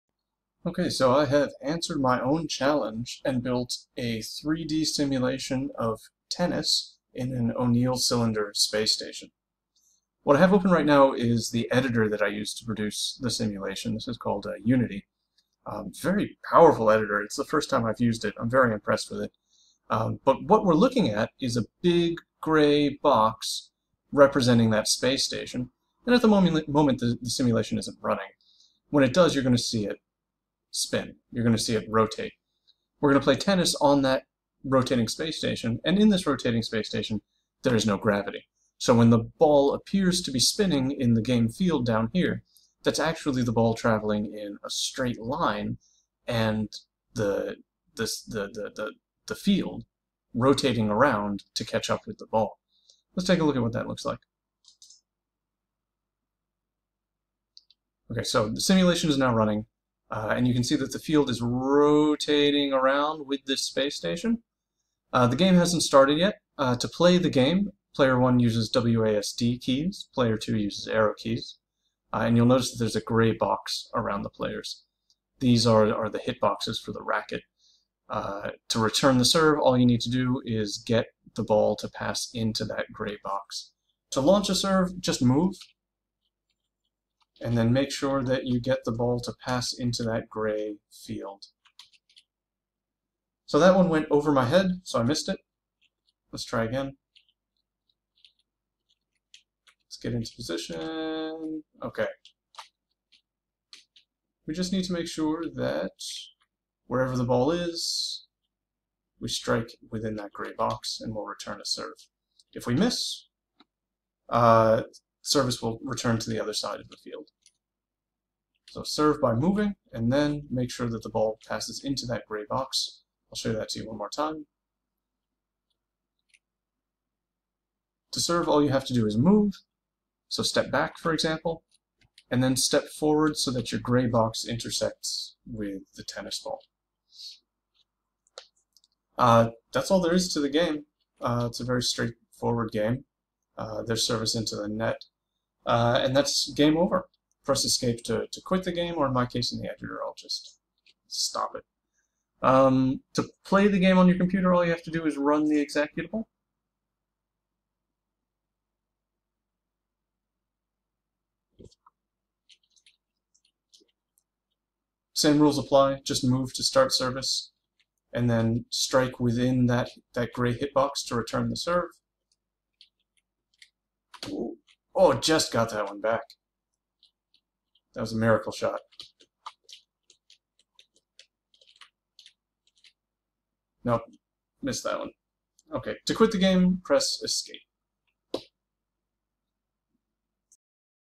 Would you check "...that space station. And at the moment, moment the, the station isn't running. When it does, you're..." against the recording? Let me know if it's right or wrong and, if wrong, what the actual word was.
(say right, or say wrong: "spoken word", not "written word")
wrong: "simulation", not "station".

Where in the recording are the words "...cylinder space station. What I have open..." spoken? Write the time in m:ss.
0:07.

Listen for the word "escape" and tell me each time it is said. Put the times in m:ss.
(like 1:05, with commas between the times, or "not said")
2:27, 3:07.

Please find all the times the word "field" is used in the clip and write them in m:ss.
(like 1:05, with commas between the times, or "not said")
0:41, 0:49, 1:00, 1:31, 1:56.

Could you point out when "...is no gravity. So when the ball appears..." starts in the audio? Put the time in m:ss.
0:37.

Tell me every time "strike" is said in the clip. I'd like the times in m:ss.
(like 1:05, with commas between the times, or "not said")
1:49, 2:48.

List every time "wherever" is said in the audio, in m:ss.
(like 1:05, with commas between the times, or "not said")
1:46.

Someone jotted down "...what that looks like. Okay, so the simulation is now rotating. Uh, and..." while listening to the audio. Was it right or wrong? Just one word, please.
wrong.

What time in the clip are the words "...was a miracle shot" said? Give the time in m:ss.
2:58.